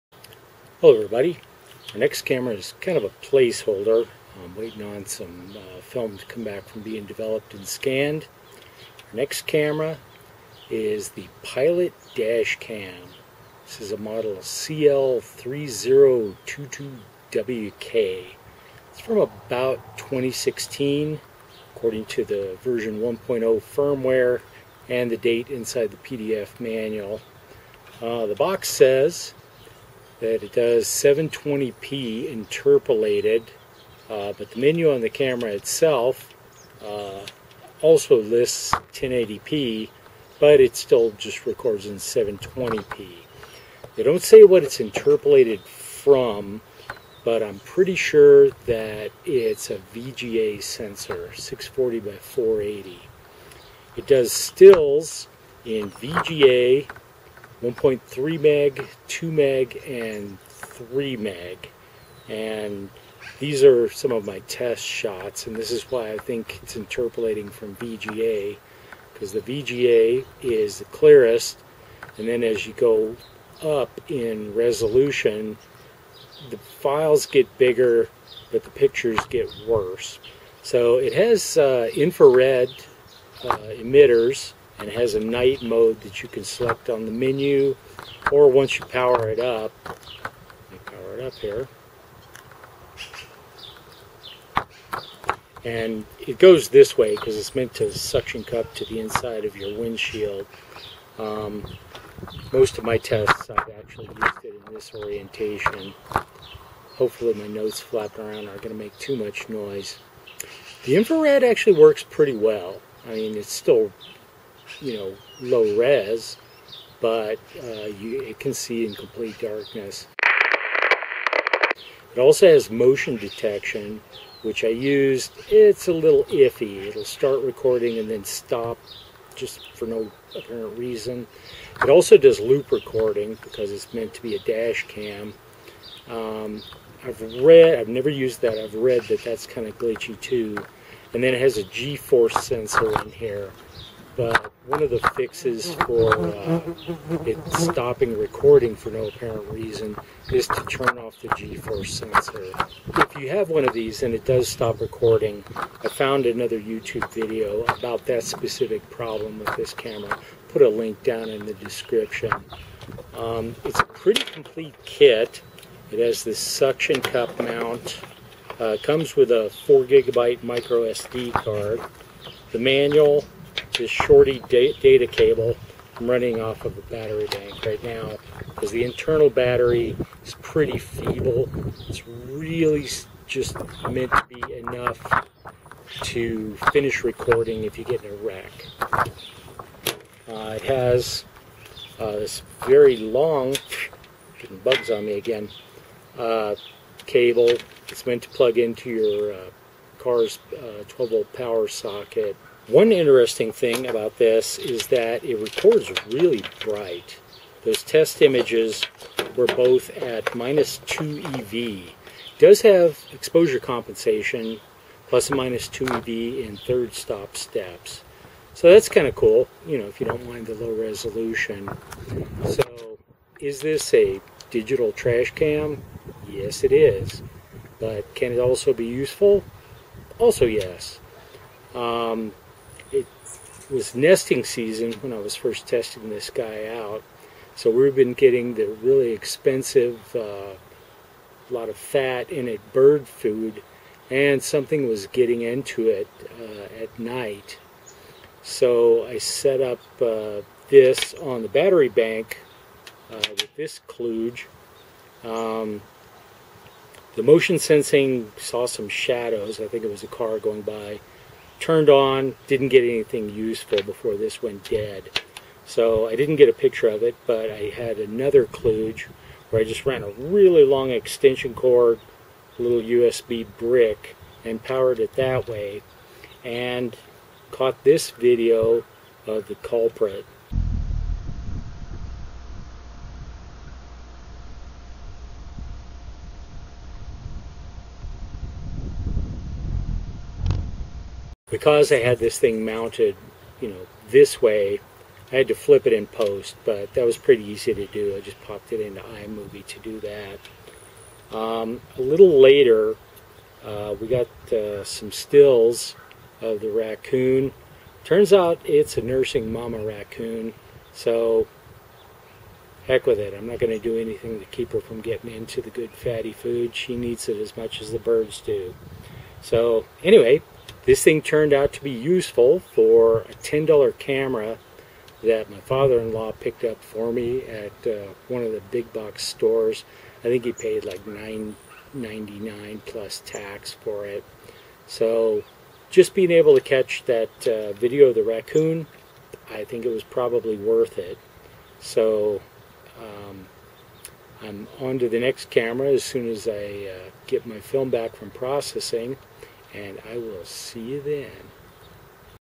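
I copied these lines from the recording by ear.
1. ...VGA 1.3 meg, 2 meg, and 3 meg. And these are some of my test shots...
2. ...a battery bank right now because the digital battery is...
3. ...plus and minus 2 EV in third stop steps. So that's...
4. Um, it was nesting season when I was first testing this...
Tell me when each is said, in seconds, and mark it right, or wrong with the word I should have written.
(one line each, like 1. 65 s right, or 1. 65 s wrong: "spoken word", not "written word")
1. 55 s right
2. 176 s wrong: "internal", not "digital"
3. 215 s right
4. 231 s right.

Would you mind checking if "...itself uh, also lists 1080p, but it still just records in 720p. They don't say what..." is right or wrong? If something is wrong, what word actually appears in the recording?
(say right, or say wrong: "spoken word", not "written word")
right.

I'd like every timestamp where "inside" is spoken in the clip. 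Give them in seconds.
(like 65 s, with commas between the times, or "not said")
25 s, 98 s.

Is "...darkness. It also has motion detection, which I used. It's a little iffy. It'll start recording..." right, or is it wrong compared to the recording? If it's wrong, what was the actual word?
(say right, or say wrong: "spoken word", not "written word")
right.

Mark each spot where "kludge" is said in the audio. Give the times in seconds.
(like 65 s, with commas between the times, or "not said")
253 s, 268 s.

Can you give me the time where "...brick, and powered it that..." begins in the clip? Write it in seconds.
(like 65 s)
273 s.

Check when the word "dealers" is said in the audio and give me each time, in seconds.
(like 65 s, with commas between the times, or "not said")
not said.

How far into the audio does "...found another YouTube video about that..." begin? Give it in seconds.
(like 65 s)
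155 s.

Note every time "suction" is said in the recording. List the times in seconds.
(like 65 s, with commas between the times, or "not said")
97 s, 166 s.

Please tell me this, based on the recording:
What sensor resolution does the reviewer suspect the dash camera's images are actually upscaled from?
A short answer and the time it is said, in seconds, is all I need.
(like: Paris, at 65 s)
640 by 480, at 51 s.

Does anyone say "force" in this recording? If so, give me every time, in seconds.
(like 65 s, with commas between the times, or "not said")
141 s, 151 s.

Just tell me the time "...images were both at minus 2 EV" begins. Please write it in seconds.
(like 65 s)
208 s.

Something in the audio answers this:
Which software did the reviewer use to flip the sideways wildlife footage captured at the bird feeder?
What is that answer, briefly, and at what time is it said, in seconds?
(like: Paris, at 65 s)
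iMovie, at 299 s.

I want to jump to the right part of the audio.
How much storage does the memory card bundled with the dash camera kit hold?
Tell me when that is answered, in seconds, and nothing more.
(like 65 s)
169 s.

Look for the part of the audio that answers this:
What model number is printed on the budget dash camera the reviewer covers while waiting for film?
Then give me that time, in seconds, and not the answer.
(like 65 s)
14 s.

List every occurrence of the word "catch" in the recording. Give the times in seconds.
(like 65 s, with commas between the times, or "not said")
336 s.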